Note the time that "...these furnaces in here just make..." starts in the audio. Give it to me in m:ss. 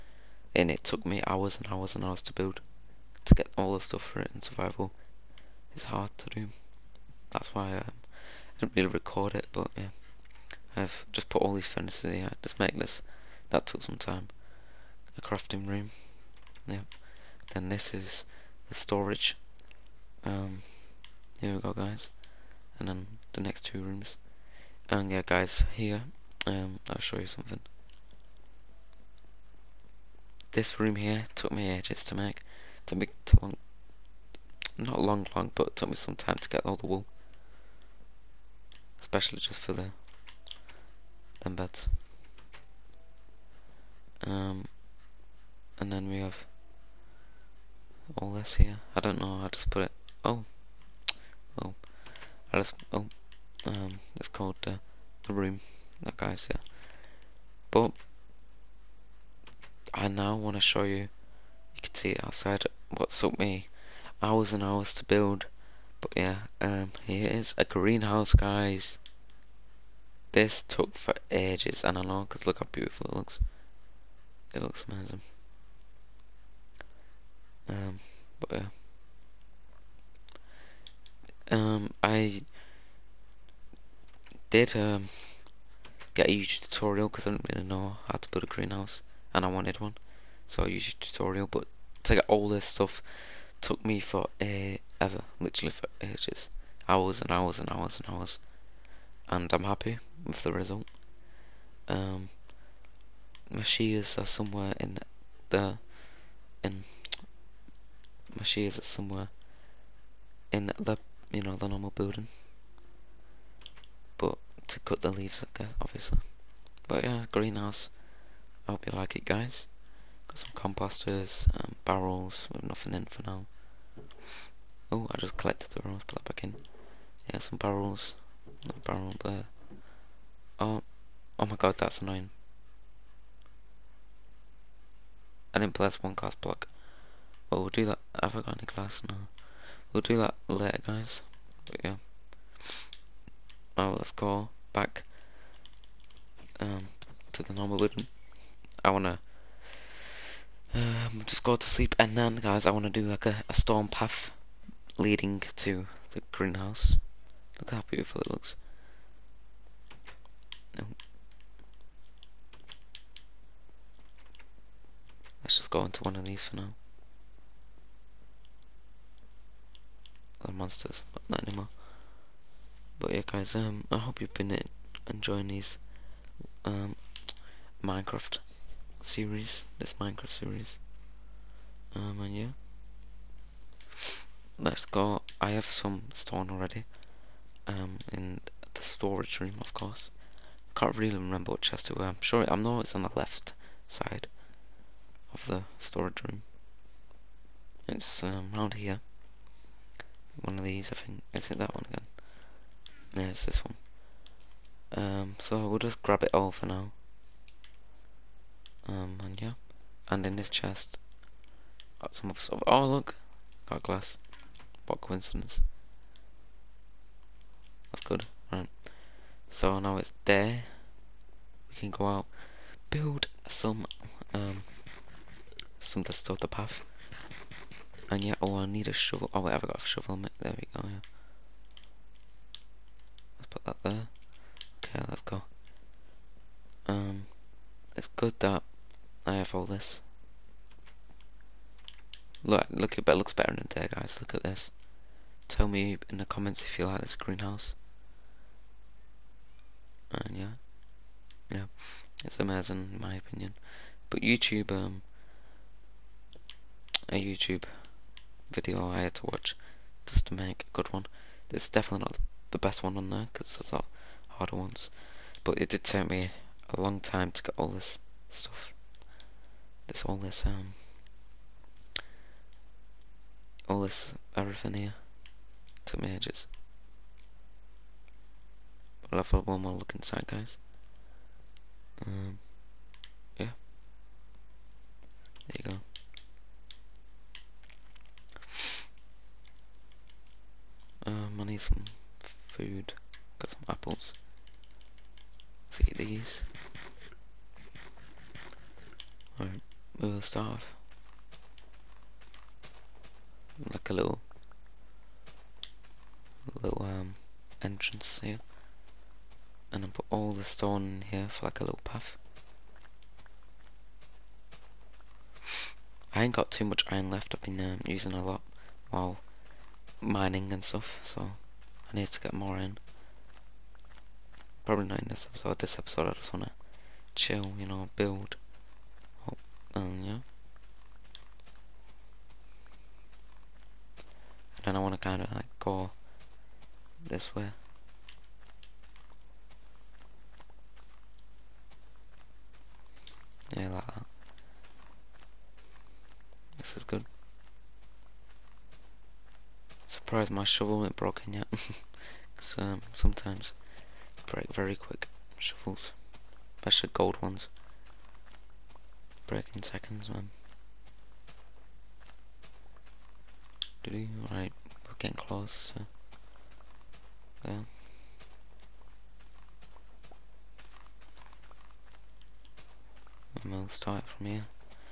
0:11.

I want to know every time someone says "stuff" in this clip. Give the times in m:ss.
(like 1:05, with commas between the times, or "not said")
0:03, 1:32, 3:32, 3:46, 4:28, 5:20.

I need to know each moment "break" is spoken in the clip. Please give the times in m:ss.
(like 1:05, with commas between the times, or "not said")
5:54, 5:59.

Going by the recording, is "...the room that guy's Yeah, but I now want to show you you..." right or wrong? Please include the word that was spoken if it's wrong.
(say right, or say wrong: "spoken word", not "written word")
right.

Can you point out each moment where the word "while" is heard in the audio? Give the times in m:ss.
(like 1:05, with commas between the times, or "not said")
5:18.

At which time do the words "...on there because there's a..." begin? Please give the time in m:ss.
4:22.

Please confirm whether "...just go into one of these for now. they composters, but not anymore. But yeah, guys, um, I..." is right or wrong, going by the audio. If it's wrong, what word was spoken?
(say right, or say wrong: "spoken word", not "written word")
wrong: "monsters", not "composters".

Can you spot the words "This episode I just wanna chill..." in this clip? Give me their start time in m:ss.
5:25.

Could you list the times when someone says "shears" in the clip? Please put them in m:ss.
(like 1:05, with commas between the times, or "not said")
1:43, 1:48.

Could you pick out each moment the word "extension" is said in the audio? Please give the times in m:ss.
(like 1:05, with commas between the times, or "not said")
not said.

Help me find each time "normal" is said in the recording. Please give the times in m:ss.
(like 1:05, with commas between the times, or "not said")
1:51, 2:27.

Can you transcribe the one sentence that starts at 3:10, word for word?
Can't really remember what chest it was.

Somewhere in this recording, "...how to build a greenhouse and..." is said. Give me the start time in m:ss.
1:28.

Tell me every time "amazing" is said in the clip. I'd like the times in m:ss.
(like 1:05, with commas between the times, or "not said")
1:14, 4:12.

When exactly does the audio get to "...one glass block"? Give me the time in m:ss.
2:16.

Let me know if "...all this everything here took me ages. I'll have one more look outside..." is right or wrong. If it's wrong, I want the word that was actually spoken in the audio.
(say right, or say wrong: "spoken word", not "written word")
wrong: "inside", not "outside".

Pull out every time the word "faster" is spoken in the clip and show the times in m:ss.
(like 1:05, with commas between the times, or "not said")
not said.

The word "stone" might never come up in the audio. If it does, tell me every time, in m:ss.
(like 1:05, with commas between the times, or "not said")
3:06, 5:10.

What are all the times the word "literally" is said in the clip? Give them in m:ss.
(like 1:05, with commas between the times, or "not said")
1:35.